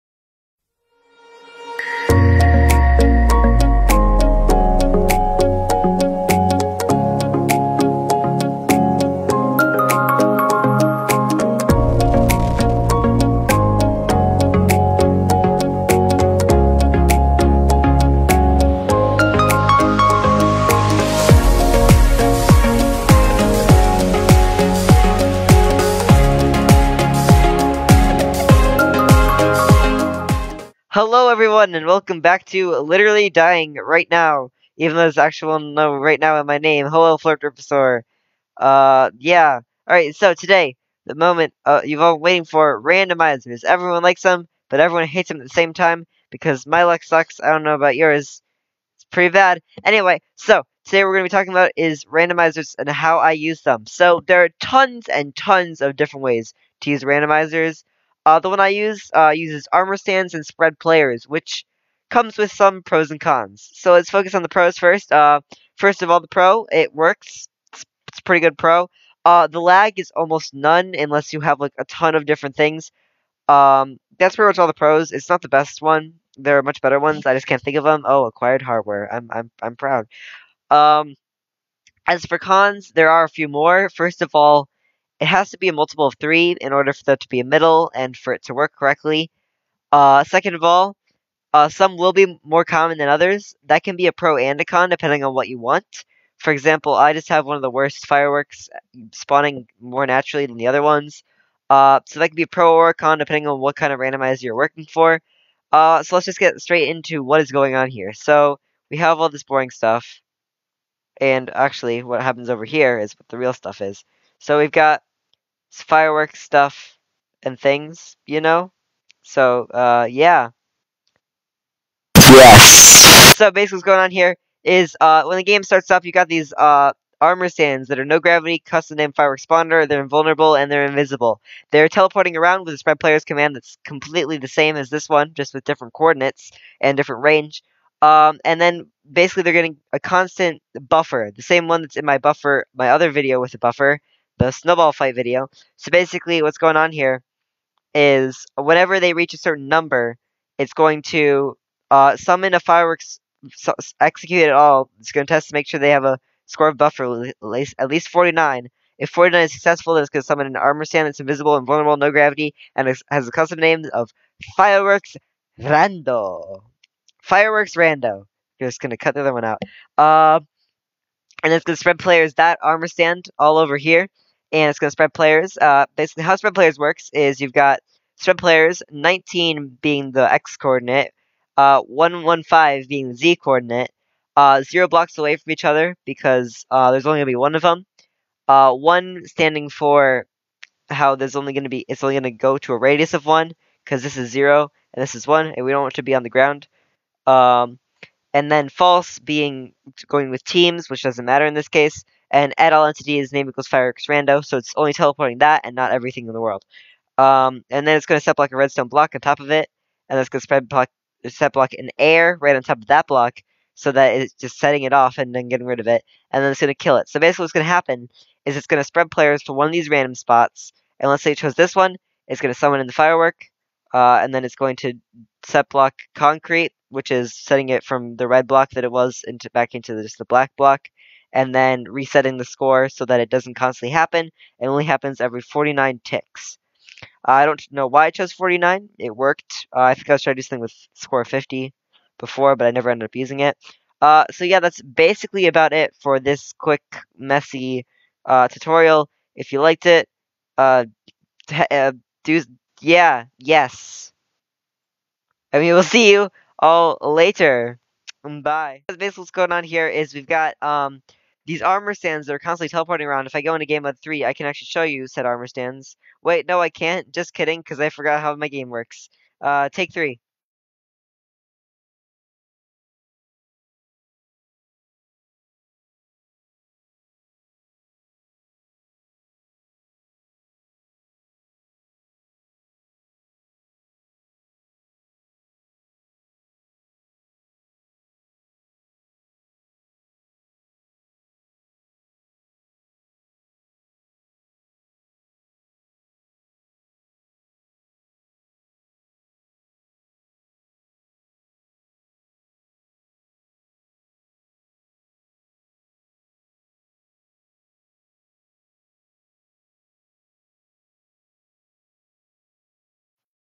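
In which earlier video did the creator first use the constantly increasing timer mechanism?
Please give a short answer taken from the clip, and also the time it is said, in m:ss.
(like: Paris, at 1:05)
snowball fight video, at 2:24.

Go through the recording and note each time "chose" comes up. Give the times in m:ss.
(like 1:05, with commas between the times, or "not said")
3:41, 3:58.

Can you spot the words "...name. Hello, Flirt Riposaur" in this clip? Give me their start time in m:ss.
0:36.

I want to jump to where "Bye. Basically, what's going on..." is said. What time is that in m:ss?
4:18.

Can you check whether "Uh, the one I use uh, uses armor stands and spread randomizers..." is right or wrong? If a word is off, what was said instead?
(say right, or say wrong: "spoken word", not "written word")
wrong: "players", not "randomizers".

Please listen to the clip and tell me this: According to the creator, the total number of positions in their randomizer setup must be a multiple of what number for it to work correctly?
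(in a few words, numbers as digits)
3.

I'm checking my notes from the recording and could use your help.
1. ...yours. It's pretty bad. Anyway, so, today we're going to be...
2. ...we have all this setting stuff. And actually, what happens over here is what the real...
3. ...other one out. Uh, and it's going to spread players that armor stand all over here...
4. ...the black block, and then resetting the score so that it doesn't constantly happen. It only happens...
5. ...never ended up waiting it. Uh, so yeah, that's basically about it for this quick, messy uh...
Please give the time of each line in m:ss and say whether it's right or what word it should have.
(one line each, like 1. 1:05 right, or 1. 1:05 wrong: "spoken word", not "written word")
1. 0:47 right
2. 1:48 wrong: "boring", not "setting"
3. 2:49 right
4. 3:50 right
5. 4:02 wrong: "using", not "waiting".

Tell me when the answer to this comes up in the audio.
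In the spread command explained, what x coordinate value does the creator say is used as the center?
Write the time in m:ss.
2:58.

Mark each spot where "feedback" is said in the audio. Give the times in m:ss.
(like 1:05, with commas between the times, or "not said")
not said.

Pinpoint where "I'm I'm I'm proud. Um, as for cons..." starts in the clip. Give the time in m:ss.
1:19.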